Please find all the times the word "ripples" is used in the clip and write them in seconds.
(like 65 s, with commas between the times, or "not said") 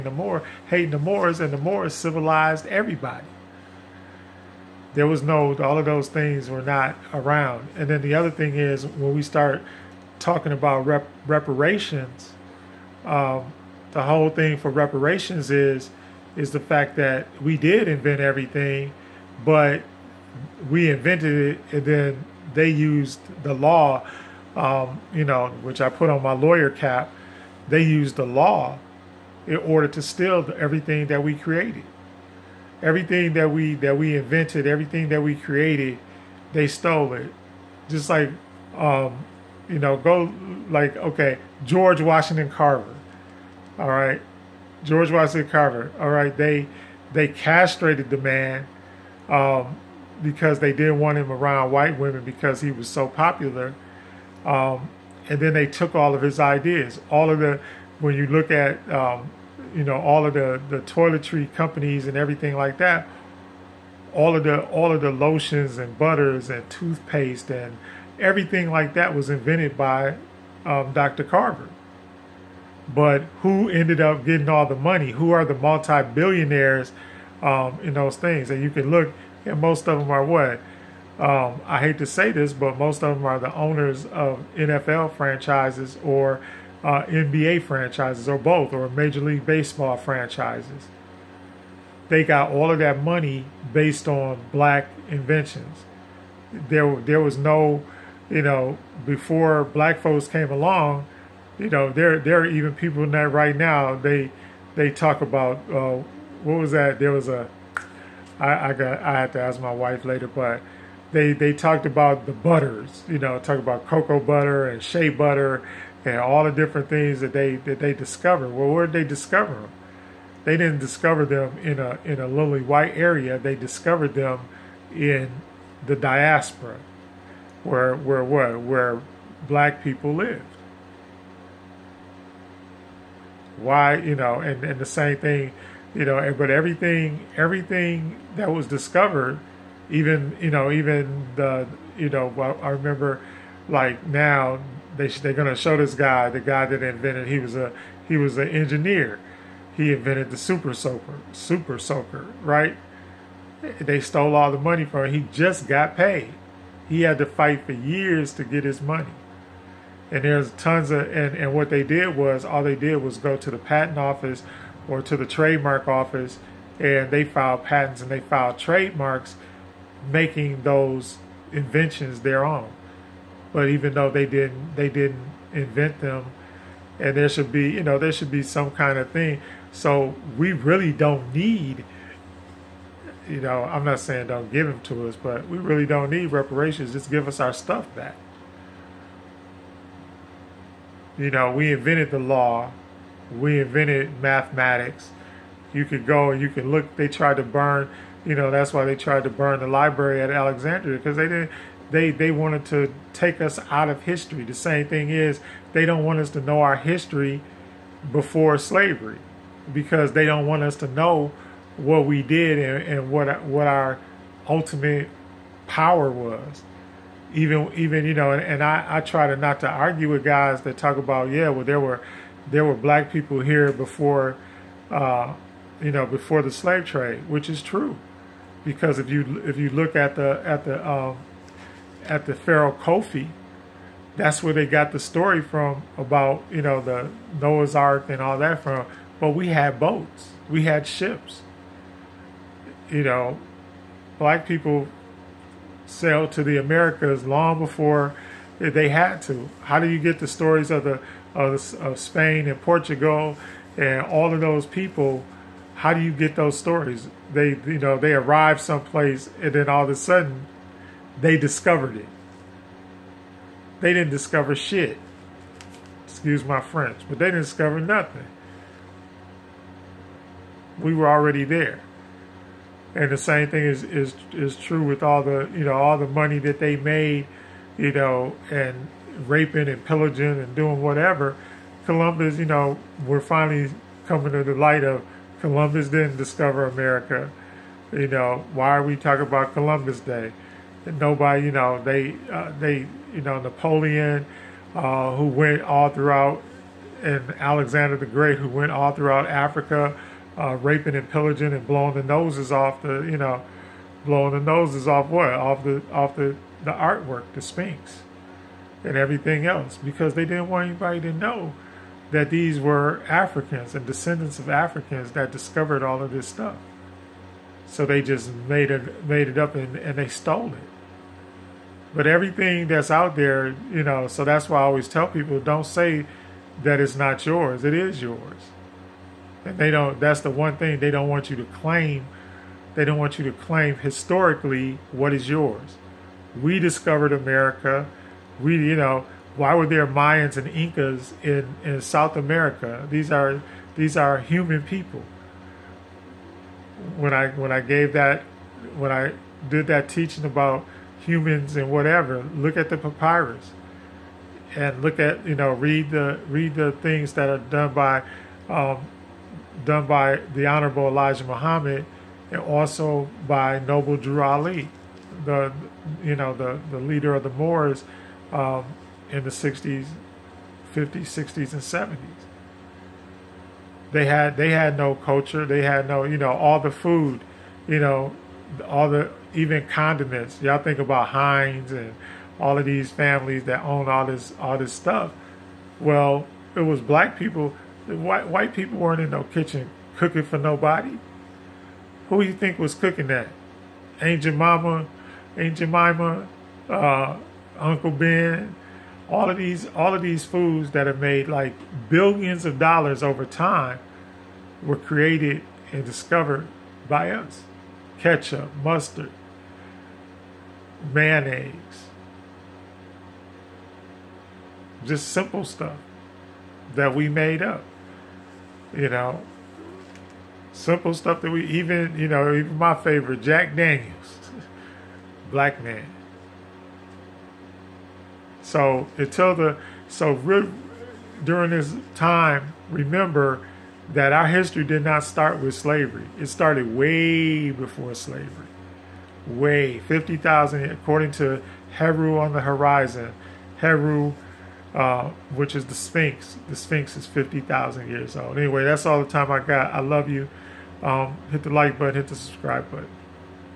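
not said.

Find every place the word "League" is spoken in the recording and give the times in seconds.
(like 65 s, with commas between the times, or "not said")
89 s.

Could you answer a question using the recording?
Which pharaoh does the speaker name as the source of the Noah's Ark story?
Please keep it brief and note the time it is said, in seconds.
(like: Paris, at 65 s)
Khufu, at 232 s.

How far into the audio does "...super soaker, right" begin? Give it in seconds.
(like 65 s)
151 s.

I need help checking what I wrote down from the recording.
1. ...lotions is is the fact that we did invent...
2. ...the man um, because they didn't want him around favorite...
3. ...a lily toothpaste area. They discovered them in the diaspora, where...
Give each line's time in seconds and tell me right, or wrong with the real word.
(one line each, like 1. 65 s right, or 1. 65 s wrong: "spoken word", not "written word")
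1. 14 s wrong: "reparations", not "lotions"
2. 48 s wrong: "white", not "favorite"
3. 122 s wrong: "white", not "toothpaste".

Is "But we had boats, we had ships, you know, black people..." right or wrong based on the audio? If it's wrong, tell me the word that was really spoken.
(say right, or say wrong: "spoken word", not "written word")
right.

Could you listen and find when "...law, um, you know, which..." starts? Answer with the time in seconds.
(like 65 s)
23 s.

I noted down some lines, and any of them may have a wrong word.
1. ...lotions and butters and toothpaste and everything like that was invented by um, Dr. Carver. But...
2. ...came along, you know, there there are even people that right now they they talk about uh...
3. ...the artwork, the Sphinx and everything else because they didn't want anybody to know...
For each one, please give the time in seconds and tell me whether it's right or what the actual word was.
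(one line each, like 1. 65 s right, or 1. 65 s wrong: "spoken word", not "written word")
1. 65 s right
2. 100 s right
3. 306 s right.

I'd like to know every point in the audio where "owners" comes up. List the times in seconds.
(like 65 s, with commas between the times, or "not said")
83 s.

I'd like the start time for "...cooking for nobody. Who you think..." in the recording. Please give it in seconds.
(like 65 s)
389 s.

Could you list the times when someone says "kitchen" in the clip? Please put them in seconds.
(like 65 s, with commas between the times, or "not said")
389 s.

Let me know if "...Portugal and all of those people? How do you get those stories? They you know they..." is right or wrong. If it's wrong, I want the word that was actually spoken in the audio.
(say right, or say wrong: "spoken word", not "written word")
right.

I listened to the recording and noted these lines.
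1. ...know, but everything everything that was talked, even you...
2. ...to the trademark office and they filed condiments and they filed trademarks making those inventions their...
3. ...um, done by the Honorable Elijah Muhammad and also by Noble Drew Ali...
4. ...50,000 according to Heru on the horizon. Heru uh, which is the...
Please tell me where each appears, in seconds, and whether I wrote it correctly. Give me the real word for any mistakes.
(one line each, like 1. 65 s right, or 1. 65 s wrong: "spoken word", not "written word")
1. 136 s wrong: "discovered", not "talked"
2. 165 s wrong: "patents", not "condiments"
3. 358 s right
4. 439 s right.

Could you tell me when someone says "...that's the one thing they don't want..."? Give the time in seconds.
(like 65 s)
329 s.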